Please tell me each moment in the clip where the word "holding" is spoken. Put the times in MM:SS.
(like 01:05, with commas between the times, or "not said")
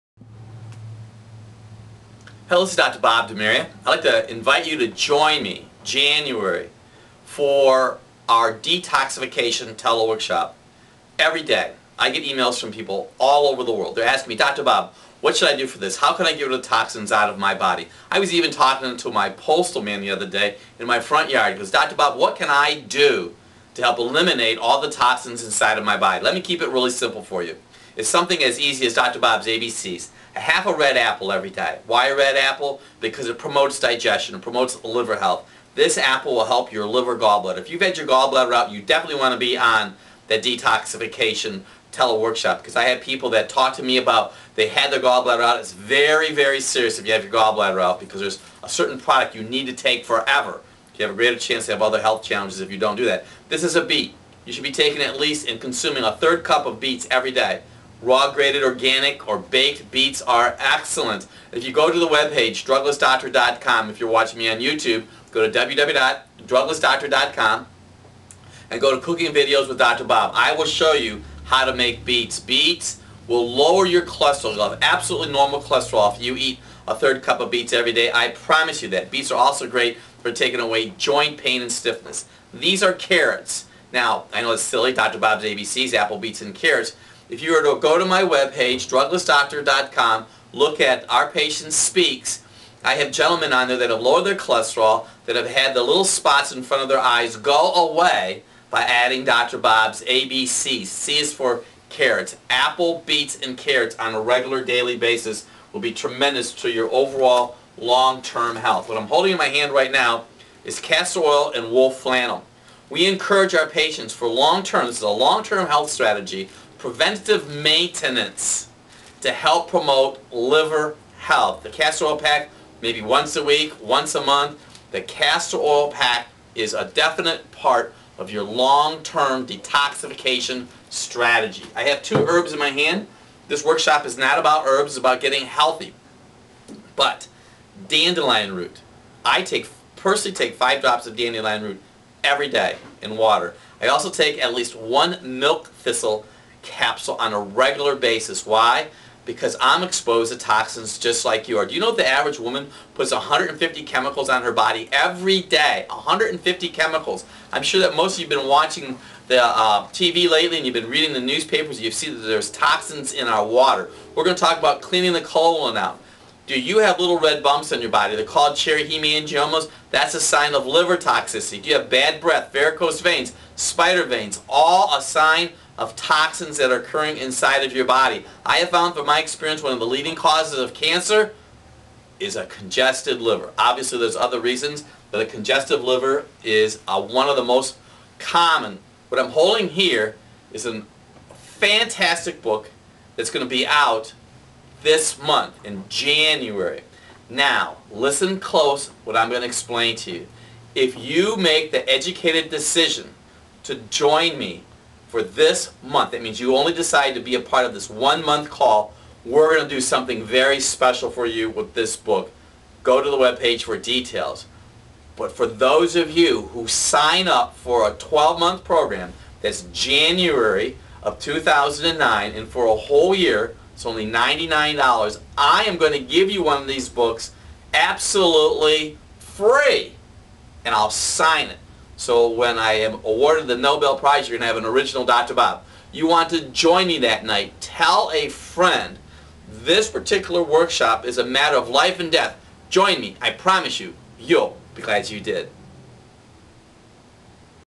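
01:49, 03:09.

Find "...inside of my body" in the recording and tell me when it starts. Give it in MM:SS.
00:25.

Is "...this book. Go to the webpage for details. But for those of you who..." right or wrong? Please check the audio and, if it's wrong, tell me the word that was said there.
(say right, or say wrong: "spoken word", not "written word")
right.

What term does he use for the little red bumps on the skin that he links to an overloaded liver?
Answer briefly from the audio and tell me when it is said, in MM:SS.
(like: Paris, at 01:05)
Cherry hemangiomas, at 02:48.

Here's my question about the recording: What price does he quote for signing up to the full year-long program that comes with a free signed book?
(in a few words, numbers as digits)
$99.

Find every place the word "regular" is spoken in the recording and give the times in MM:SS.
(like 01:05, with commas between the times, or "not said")
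01:44, 02:27.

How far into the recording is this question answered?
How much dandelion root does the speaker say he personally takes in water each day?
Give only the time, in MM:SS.
02:20.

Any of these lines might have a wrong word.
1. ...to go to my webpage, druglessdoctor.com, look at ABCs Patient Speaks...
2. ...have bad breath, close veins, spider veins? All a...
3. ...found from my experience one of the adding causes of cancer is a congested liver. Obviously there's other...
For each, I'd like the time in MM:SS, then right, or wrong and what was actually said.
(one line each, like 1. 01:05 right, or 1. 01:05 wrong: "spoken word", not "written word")
1. 01:27 wrong: "Our", not "ABCs"
2. 02:51 wrong: "varicose", not "close"
3. 02:58 wrong: "leading", not "adding".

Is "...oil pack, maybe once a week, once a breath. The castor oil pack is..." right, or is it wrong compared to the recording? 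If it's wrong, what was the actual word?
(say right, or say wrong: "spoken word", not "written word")
wrong: "month", not "breath".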